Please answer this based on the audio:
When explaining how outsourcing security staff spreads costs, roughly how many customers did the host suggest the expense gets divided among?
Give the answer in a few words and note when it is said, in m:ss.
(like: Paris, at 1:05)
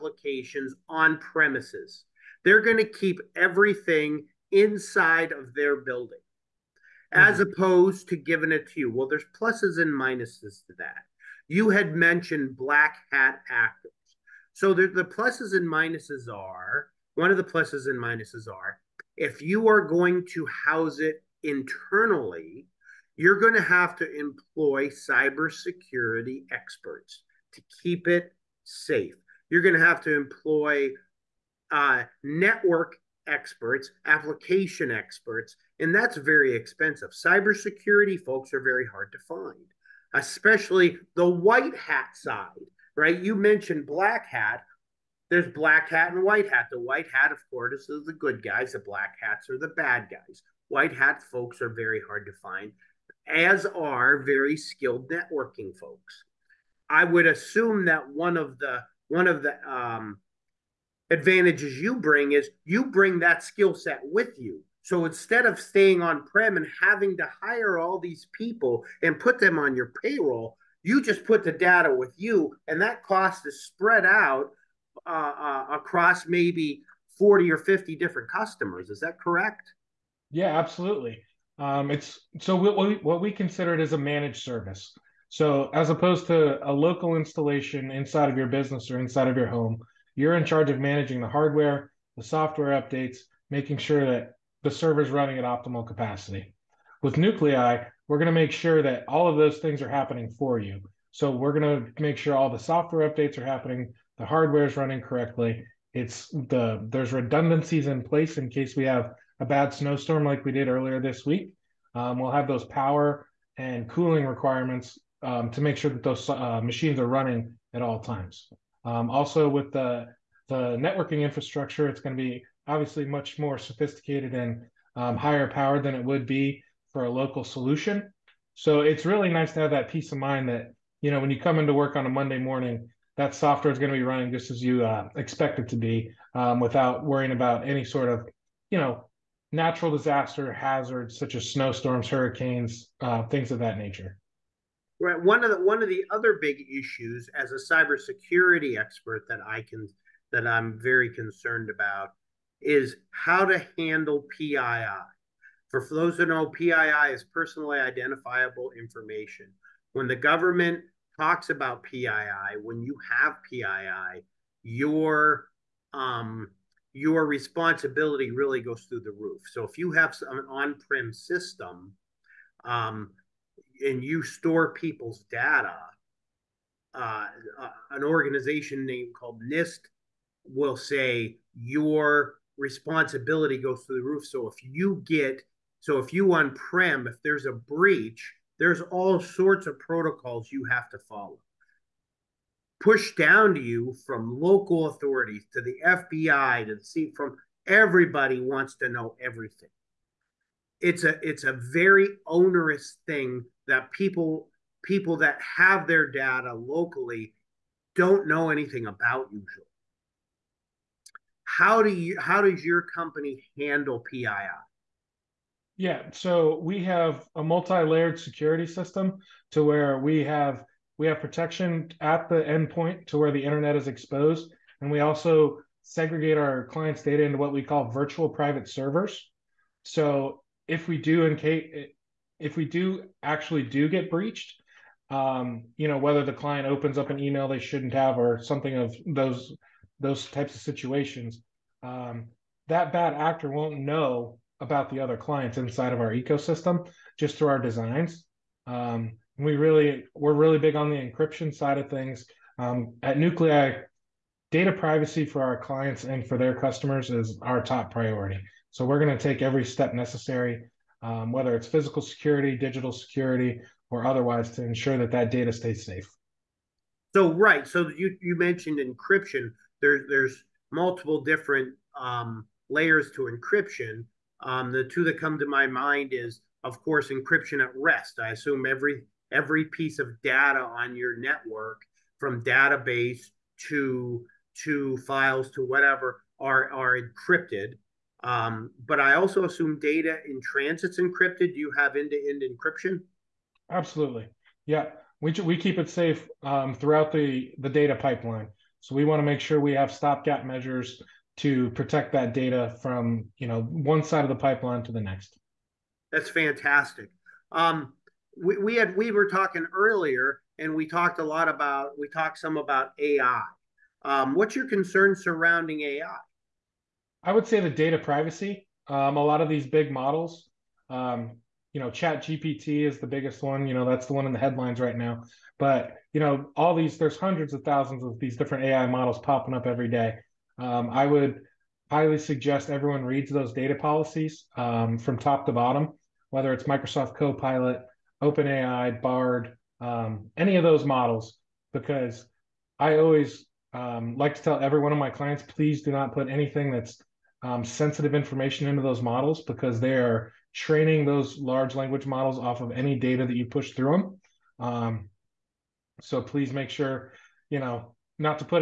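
40 or 50, at 1:17.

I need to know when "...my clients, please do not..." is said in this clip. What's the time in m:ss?
5:44.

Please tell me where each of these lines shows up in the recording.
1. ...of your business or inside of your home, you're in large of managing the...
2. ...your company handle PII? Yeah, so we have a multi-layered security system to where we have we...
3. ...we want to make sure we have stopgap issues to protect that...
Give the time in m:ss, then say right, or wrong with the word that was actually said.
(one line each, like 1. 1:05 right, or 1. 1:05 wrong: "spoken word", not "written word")
1. 1:28 wrong: "charge", not "large"
2. 3:32 right
3. 4:58 wrong: "measures", not "issues".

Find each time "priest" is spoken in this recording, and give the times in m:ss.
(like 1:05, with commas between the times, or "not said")
not said.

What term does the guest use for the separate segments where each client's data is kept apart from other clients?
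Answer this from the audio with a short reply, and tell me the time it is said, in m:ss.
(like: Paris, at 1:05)
virtual private servers, at 3:47.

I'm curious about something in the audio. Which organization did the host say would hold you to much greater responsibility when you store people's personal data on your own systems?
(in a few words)
NIST.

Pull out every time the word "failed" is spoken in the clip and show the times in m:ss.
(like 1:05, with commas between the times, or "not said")
not said.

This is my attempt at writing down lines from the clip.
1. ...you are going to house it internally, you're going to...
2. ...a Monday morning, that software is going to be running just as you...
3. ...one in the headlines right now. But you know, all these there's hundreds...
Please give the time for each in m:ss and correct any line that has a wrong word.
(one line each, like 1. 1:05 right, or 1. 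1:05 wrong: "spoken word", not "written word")
1. 0:19 right
2. 2:12 right
3. 5:24 right.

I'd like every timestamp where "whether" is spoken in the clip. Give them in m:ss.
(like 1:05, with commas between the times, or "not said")
3:55, 4:21, 5:36.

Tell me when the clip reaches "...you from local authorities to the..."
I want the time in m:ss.
3:13.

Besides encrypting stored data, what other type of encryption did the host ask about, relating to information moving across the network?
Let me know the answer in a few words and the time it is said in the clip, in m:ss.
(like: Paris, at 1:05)
data in transit, at 4:49.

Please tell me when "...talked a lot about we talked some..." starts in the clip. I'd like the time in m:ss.
5:10.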